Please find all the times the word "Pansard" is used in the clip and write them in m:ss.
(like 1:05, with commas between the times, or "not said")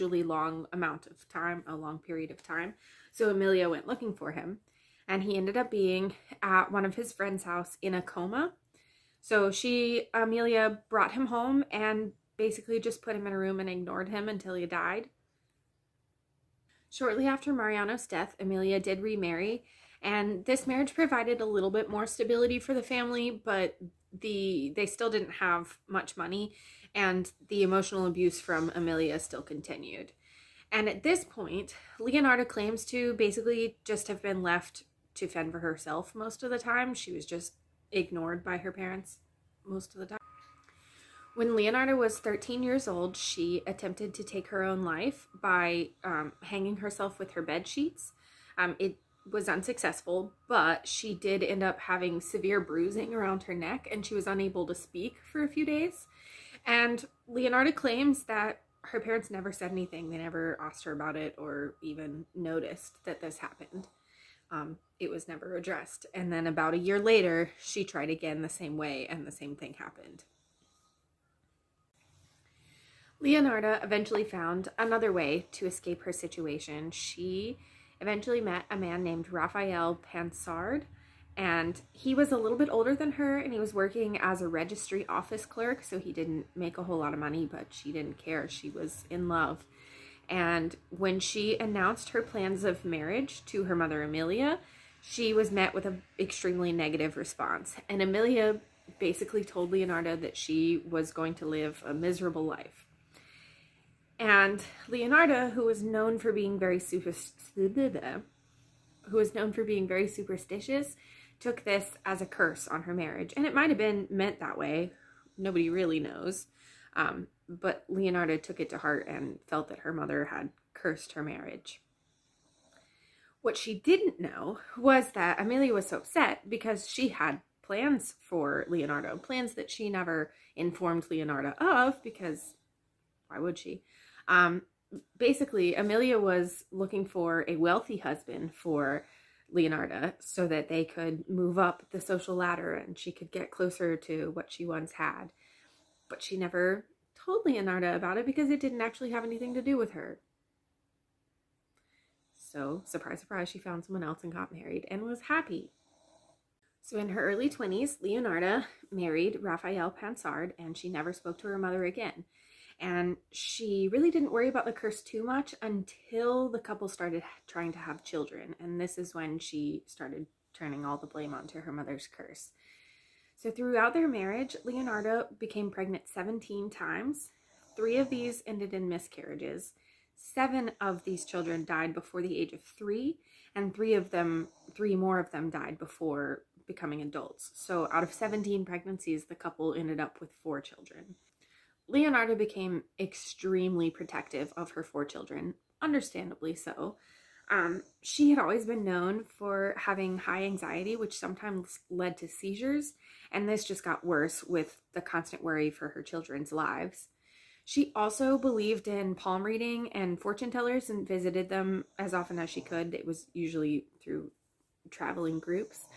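1:19, 2:39.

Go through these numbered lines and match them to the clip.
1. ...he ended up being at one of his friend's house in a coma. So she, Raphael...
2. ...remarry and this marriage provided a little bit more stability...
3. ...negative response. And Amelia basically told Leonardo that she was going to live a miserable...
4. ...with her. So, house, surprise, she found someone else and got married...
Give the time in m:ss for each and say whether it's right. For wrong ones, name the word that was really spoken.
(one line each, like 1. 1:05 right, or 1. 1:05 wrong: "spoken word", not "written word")
1. 0:05 wrong: "Amelia", not "Raphael"
2. 0:19 right
3. 1:36 right
4. 2:29 wrong: "surprise", not "house".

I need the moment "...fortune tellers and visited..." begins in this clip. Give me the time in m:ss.
3:30.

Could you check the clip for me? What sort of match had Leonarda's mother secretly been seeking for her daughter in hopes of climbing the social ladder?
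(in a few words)
a wealthy husband.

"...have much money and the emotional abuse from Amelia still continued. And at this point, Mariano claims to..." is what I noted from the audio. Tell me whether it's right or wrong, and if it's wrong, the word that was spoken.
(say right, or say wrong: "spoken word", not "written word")
wrong: "Leonardo", not "Mariano".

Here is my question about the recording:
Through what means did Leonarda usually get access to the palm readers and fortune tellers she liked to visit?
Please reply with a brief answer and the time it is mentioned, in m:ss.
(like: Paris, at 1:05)
traveling groups, at 3:34.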